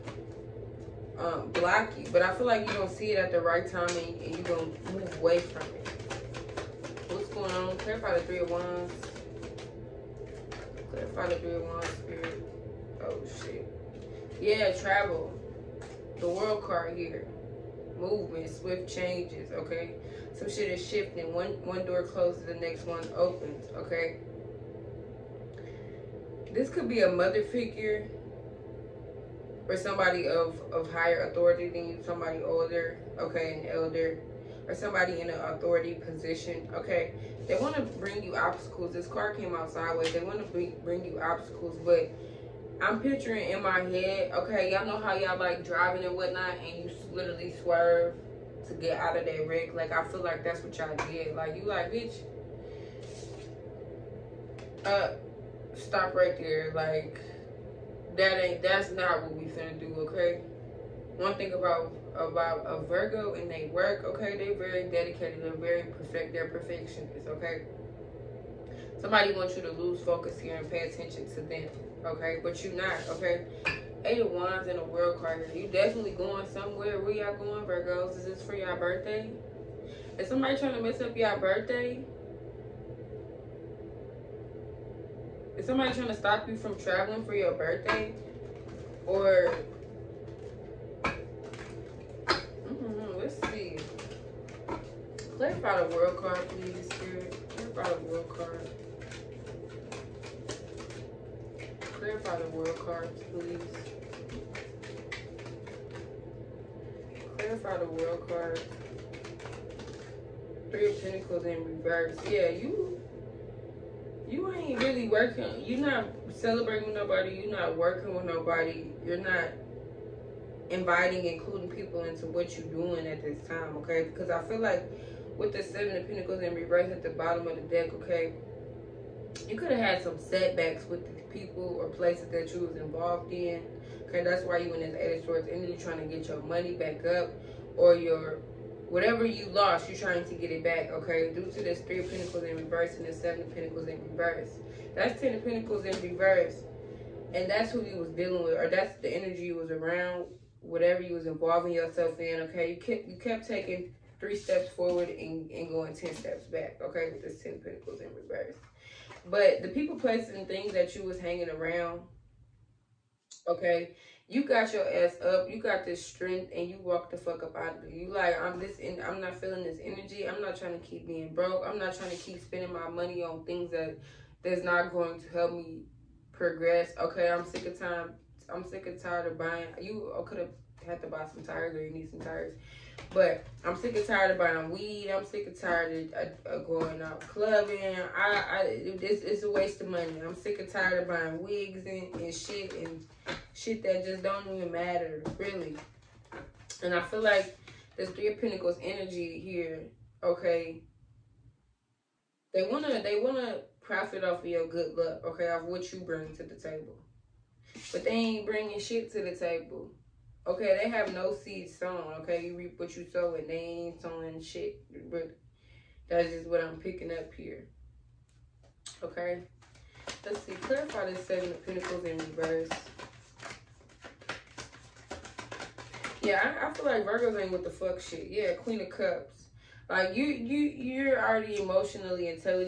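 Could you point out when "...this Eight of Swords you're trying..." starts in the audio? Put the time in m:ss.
2:14.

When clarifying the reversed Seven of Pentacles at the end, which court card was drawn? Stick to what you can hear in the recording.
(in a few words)
Queen of Cups.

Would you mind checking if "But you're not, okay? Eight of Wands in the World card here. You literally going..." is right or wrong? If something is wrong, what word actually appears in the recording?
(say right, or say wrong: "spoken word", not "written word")
wrong: "definitely", not "literally".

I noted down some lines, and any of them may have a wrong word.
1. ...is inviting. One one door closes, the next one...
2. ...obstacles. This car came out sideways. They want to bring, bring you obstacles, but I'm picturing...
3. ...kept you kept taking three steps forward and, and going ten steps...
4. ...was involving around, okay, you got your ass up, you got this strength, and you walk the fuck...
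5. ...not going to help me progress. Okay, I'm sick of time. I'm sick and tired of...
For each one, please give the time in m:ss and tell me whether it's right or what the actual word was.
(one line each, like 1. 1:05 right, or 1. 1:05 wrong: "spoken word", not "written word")
1. 0:20 wrong: "shifting", not "inviting"
2. 0:38 right
3. 2:32 right
4. 2:41 wrong: "hanging", not "involving"
5. 2:54 right.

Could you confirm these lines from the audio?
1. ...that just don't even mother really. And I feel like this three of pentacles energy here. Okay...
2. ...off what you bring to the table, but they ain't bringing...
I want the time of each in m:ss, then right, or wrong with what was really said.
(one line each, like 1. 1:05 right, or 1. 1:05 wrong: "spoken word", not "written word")
1. 3:13 wrong: "matter", not "mother"
2. 3:25 right.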